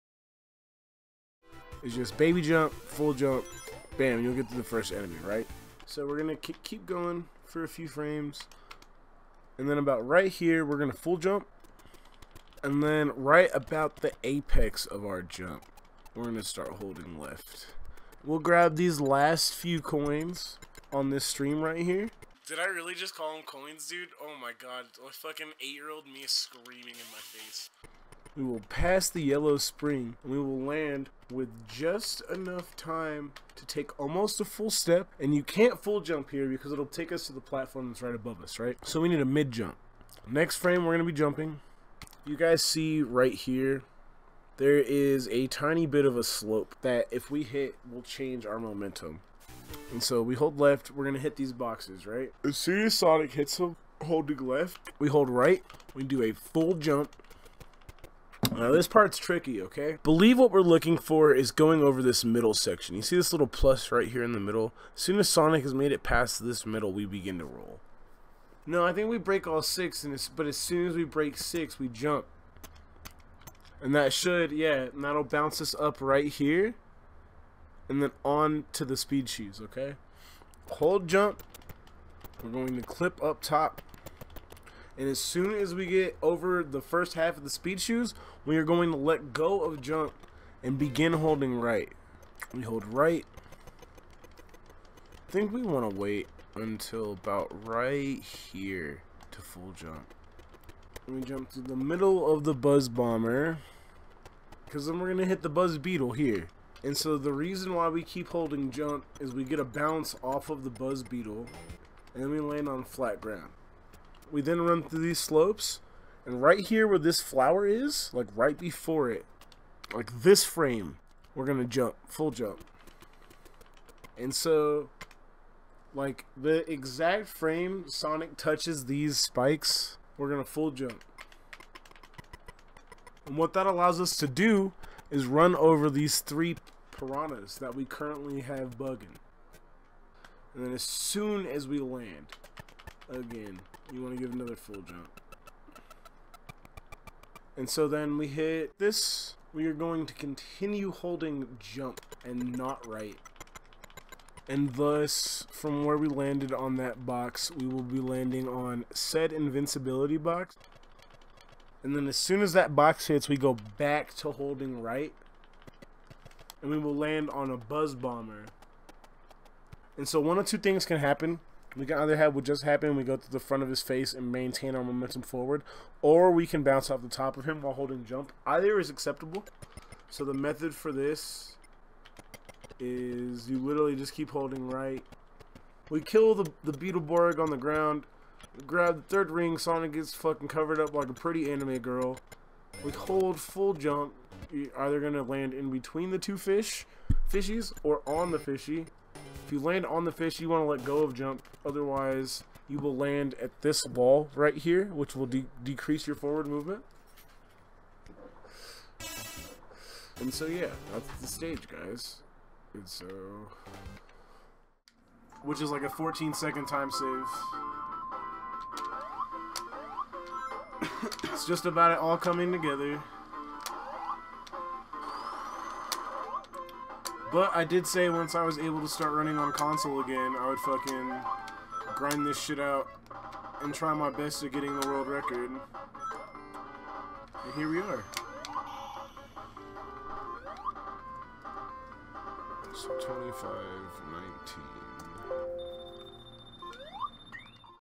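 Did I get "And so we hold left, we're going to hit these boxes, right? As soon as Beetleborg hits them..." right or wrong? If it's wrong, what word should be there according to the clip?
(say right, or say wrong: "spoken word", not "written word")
wrong: "Sonic", not "Beetleborg".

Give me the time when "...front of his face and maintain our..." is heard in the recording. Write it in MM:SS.
02:53.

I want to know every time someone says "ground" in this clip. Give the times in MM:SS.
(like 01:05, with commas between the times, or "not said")
01:53, 03:07.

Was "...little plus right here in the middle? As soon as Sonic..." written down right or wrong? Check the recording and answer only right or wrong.
right.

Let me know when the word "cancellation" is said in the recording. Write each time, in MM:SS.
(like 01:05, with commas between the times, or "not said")
not said.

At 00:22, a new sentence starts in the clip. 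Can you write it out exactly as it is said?
Did I really just call them coins, dude?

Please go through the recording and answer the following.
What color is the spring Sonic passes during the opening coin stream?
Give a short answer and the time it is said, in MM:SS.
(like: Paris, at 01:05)
Yellow, at 00:29.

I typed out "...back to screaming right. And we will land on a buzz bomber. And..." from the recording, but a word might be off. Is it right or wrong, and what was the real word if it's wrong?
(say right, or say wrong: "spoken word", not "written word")
wrong: "holding", not "screaming".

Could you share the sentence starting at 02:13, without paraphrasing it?
And what that allows us to do is run over these three piranhas that we currently have bugging.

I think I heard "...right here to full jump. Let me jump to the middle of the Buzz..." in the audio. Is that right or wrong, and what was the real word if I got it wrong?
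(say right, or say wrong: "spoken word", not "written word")
right.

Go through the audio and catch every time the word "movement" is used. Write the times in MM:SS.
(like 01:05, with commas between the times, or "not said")
03:26.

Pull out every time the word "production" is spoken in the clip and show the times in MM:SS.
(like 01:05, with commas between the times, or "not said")
not said.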